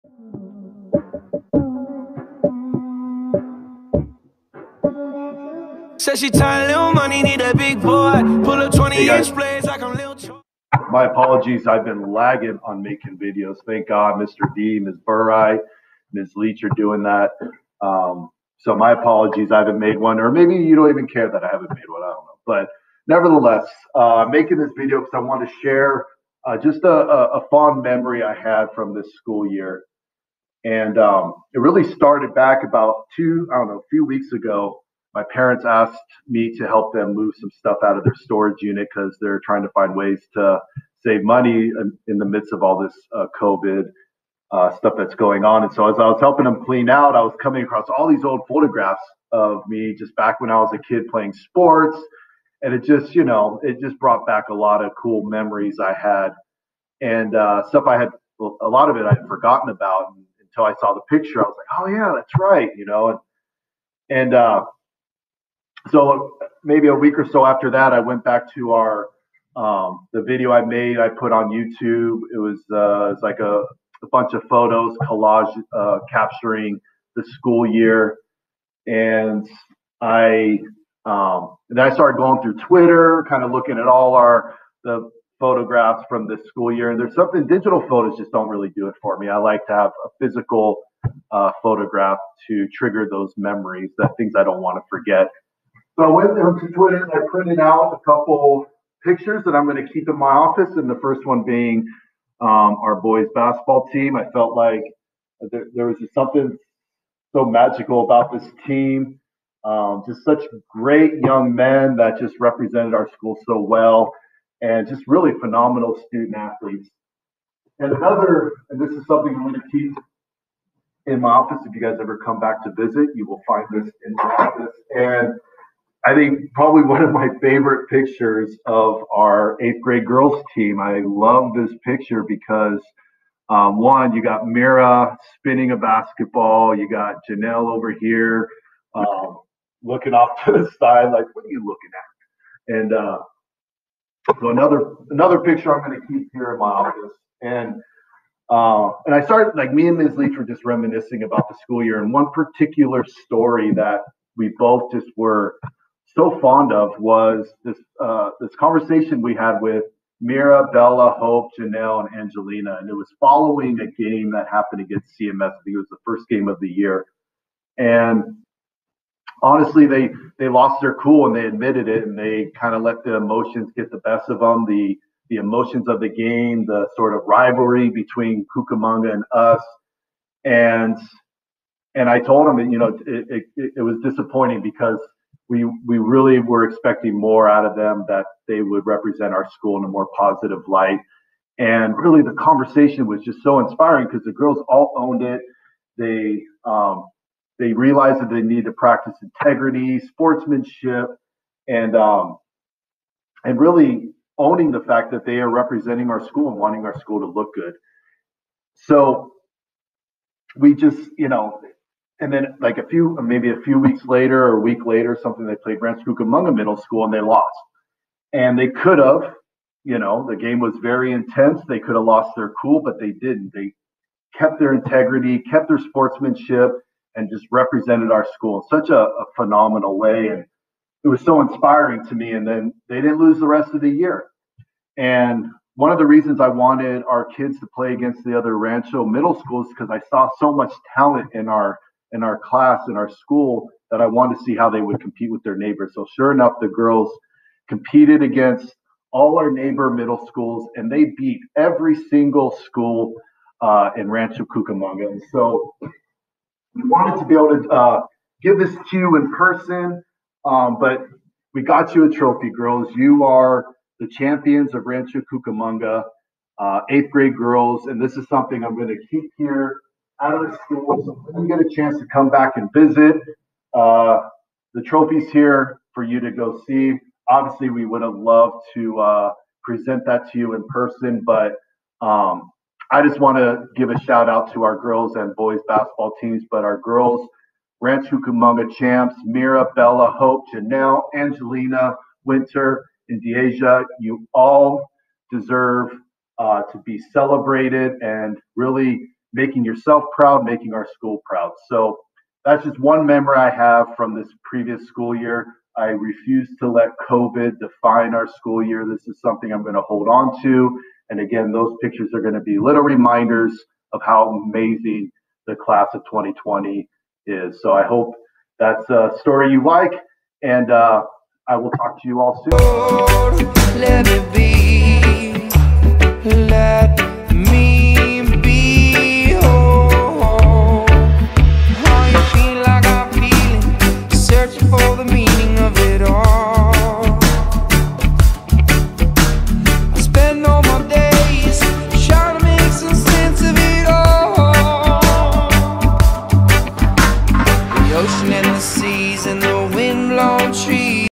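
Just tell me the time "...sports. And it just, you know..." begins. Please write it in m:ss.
0:51.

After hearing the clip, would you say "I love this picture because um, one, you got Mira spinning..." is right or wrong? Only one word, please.
right.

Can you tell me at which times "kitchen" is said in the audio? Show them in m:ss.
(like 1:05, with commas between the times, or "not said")
not said.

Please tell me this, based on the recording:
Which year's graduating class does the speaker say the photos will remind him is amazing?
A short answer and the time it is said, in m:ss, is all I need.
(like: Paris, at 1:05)
2020, at 5:16.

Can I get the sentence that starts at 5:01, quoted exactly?
So that's just one memory I have from this previous school year.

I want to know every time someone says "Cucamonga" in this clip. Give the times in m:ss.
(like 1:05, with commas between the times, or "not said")
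2:58, 3:36, 4:14, 4:25, 4:48.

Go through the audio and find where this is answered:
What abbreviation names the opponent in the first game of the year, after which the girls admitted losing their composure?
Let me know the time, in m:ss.
2:45.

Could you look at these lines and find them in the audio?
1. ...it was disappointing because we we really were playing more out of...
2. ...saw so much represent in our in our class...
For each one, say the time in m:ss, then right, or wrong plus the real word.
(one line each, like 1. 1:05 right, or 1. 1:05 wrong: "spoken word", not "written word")
1. 3:03 wrong: "expecting", not "playing"
2. 4:00 wrong: "talent", not "represent".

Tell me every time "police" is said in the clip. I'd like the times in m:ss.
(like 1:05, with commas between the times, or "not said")
not said.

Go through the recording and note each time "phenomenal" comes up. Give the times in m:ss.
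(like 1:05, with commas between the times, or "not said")
1:55, 3:49.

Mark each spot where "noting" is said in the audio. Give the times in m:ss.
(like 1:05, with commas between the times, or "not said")
not said.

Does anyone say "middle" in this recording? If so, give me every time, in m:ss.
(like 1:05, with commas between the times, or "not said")
3:36, 3:59, 4:09.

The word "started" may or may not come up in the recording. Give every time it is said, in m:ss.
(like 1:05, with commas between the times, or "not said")
0:31, 1:21, 2:29.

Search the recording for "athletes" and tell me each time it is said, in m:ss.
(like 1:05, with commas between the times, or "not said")
1:56.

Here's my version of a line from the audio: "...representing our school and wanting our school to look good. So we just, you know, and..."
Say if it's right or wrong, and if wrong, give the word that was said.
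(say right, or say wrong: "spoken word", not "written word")
right.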